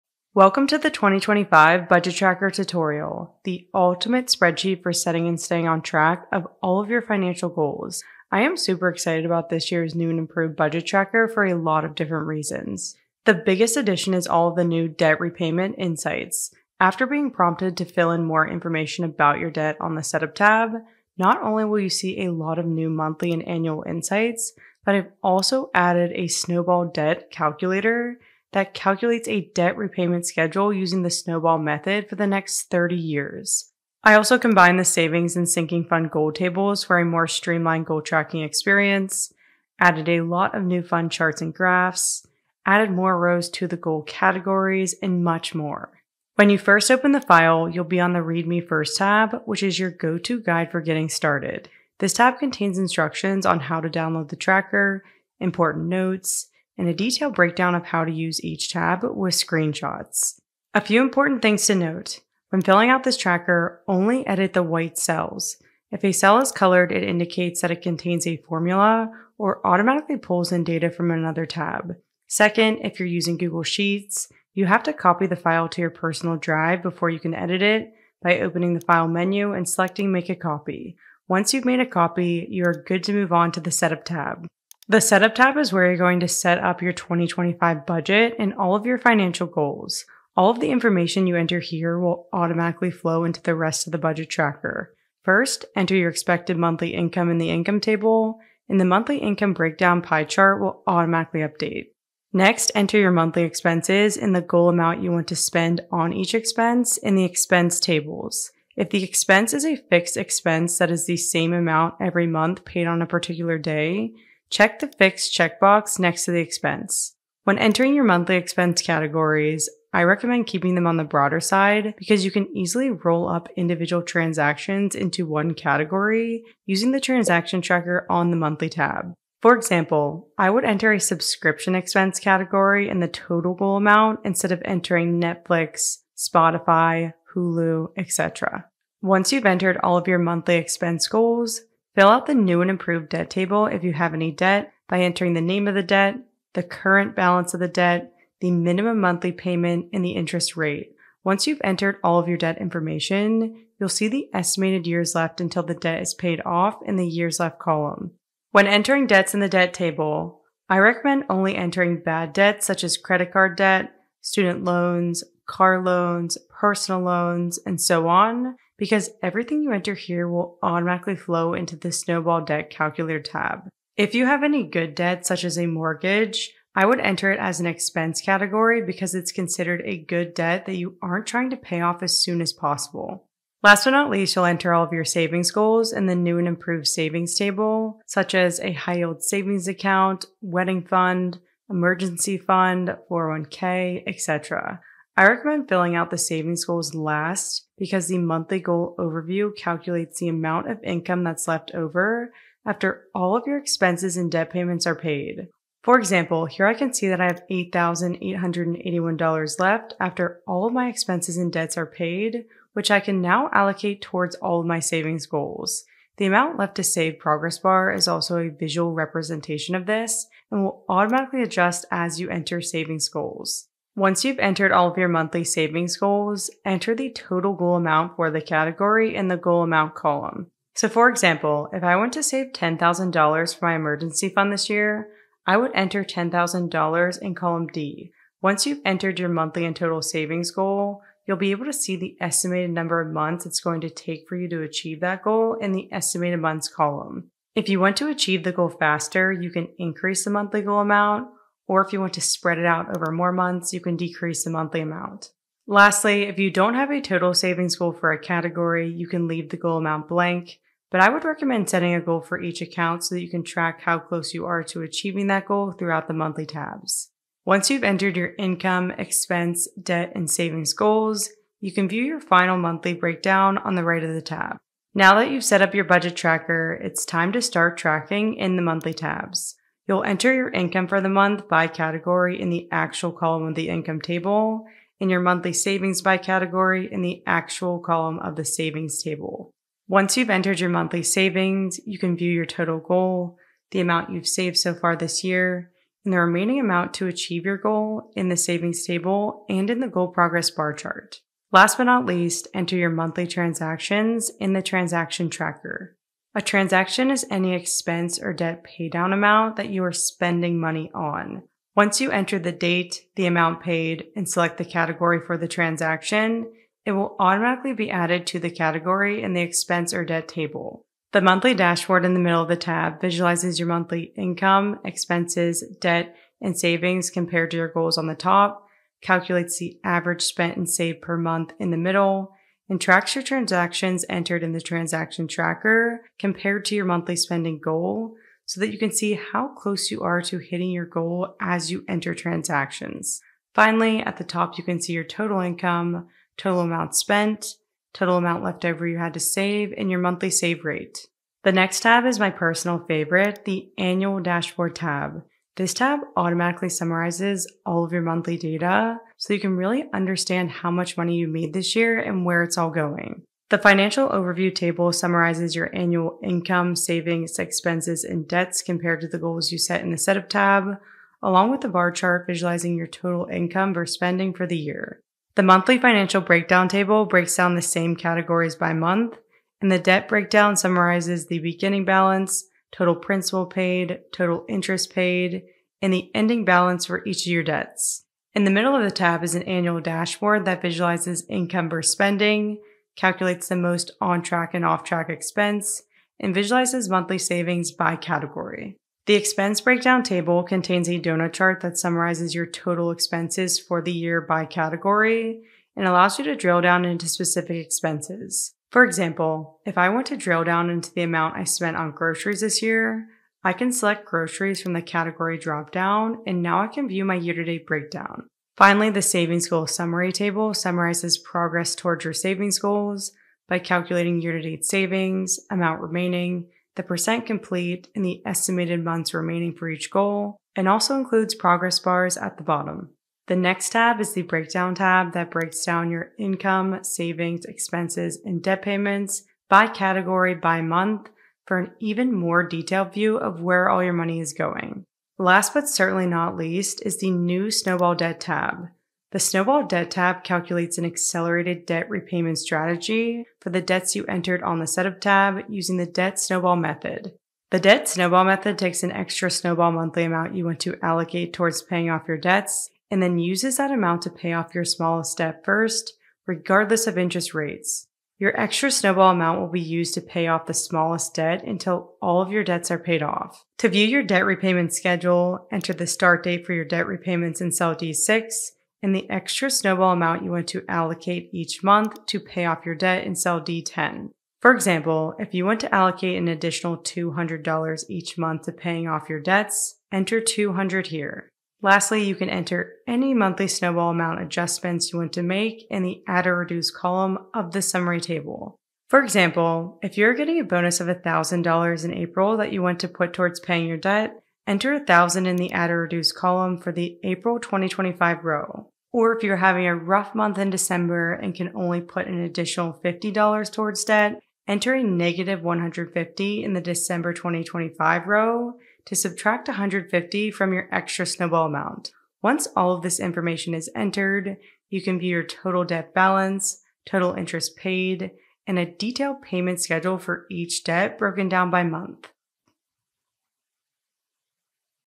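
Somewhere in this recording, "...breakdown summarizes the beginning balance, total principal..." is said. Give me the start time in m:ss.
6:20.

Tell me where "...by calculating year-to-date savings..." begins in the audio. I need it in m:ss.
7:03.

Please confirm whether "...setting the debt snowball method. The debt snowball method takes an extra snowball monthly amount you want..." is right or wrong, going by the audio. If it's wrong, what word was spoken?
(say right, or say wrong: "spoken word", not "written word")
wrong: "using", not "setting".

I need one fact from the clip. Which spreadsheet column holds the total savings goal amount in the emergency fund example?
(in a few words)
Column D.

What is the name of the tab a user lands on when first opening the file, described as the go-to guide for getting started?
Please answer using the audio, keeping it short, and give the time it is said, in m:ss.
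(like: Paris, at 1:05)
Read Me First, at 0:48.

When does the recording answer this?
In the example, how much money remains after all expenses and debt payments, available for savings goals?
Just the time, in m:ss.
3:27.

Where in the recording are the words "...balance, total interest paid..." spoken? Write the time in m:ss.
8:45.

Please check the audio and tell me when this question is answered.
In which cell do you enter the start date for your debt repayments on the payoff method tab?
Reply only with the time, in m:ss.
7:57.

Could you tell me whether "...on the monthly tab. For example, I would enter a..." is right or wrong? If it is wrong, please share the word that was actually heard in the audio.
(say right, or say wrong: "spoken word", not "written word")
right.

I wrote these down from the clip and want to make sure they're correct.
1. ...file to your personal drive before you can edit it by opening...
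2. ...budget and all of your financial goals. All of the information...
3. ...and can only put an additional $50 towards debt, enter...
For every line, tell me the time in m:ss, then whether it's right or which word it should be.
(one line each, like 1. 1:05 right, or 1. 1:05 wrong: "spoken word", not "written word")
1. 1:15 right
2. 1:27 right
3. 8:31 right.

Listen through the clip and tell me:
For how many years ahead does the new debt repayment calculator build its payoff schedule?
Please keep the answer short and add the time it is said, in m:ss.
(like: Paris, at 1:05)
30, at 0:32.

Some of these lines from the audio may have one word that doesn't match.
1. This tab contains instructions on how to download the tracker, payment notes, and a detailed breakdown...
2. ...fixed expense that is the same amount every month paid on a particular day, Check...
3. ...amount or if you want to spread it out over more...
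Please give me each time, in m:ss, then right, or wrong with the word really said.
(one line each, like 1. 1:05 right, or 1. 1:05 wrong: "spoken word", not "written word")
1. 0:51 wrong: "important", not "payment"
2. 1:49 right
3. 4:10 right.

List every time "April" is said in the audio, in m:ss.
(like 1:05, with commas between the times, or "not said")
8:21, 8:27.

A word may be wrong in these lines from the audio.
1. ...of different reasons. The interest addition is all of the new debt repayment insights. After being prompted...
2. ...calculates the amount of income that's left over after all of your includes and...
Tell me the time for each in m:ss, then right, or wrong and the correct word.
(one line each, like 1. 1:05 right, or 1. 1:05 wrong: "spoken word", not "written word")
1. 0:11 wrong: "biggest", not "interest"
2. 3:19 wrong: "expenses", not "includes".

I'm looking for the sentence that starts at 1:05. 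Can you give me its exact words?
If a cell is colored, it indicates that it contains a formula or automatically pulls in data from another tab.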